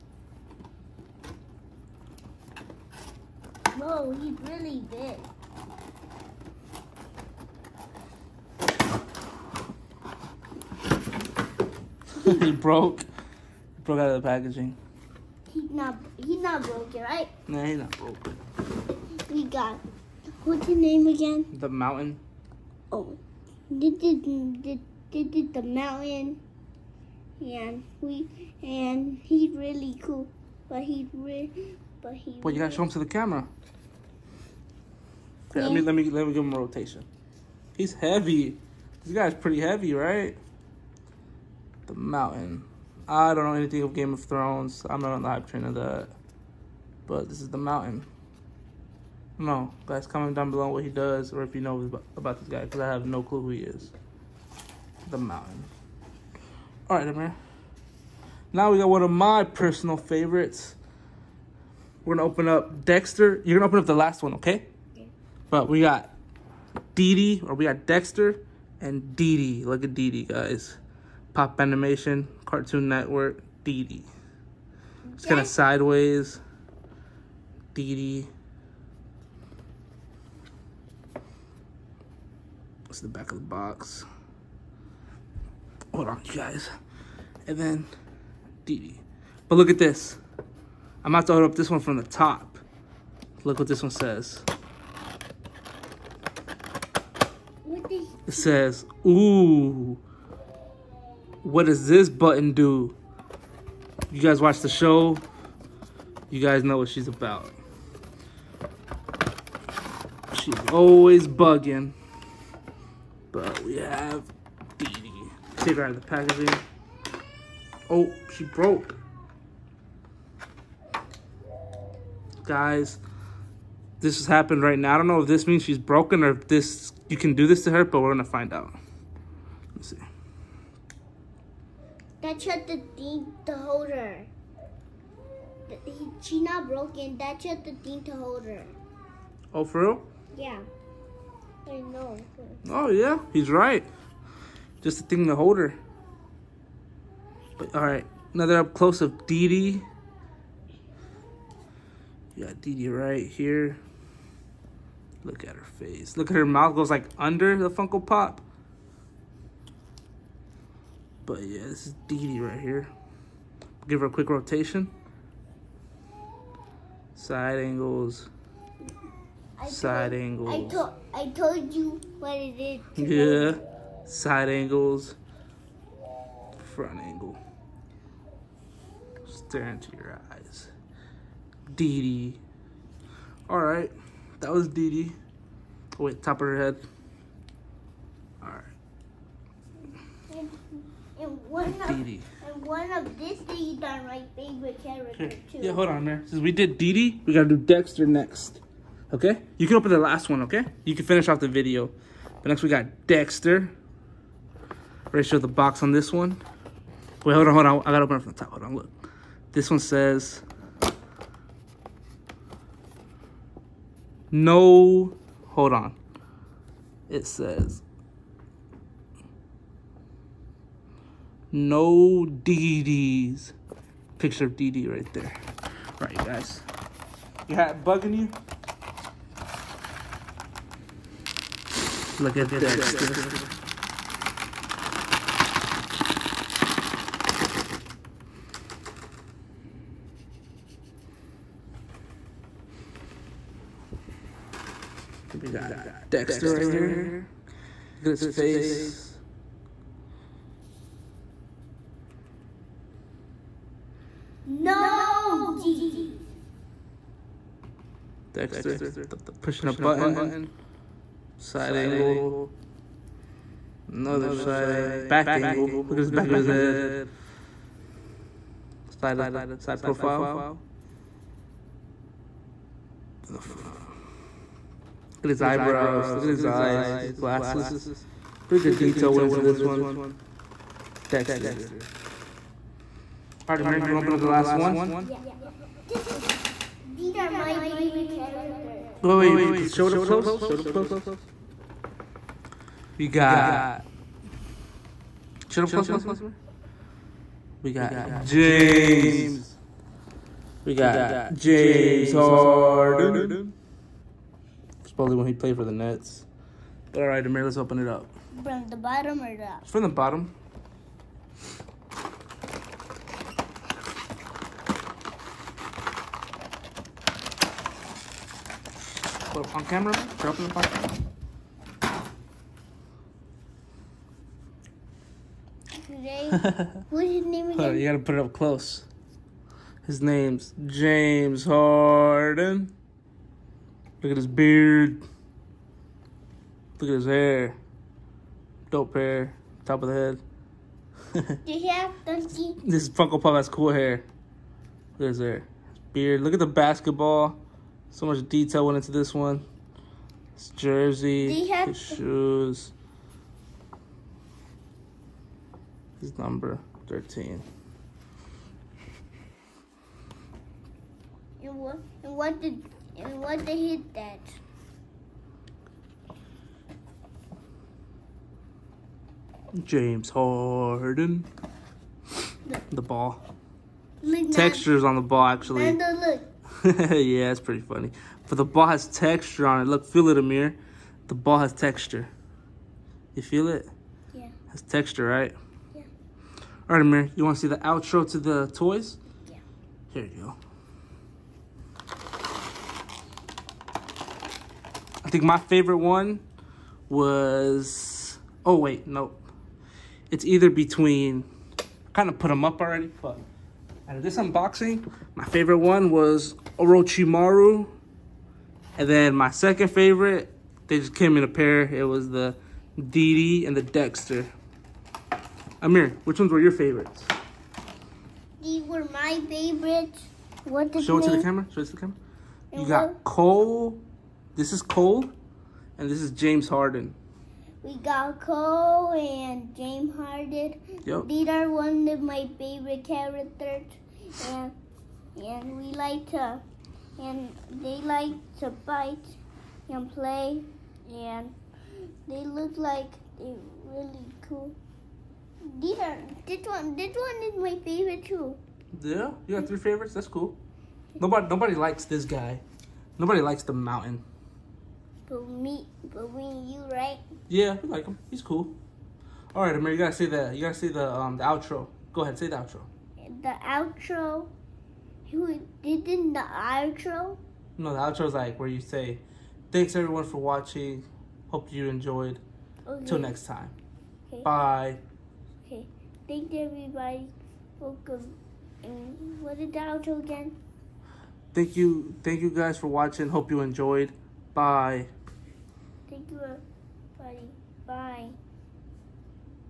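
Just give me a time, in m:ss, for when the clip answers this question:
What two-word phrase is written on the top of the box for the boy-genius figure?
3:41.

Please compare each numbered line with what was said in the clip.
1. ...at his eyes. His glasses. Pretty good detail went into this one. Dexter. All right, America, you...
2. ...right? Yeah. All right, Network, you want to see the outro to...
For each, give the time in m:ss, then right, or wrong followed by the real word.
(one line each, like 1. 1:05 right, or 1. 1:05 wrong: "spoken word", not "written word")
1. 4:36 right
2. 6:25 wrong: "Amir", not "Network".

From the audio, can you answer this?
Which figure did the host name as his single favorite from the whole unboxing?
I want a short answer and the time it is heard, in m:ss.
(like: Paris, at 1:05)
Orochimaru, at 6:46.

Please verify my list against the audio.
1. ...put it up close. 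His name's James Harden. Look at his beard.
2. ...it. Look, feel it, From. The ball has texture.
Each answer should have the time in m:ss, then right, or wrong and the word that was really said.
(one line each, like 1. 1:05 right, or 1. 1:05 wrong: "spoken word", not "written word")
1. 5:27 right
2. 6:19 wrong: "Amir", not "From".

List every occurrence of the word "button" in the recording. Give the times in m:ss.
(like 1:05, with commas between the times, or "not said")
1:42, 4:19.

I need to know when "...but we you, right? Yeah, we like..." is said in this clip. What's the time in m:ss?
7:35.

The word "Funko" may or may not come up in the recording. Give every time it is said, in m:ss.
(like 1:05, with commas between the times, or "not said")
2:37, 5:42.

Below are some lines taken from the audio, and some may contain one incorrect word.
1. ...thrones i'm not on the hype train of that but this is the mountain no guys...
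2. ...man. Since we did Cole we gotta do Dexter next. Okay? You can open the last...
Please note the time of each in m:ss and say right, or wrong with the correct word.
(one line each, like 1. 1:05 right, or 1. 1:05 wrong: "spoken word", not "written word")
1. 0:44 right
2. 3:16 wrong: "Dee", not "Cole".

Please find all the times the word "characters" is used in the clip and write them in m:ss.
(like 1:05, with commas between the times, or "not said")
3:14, 4:48, 7:12.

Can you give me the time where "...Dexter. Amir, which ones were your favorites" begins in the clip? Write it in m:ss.
6:53.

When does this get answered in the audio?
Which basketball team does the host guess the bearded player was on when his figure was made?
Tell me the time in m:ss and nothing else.
5:05.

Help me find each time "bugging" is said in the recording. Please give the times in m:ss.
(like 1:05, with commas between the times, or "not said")
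1:51, 3:47.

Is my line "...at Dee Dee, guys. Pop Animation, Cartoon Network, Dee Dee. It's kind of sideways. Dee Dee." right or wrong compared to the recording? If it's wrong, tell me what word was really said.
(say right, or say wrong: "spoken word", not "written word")
right.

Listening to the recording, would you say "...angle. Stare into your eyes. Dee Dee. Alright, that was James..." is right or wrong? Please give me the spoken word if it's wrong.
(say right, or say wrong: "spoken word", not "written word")
wrong: "Dee", not "James".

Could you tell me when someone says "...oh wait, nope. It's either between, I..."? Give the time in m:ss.
6:38.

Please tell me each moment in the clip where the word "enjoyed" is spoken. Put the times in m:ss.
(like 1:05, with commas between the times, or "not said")
7:51, 8:03.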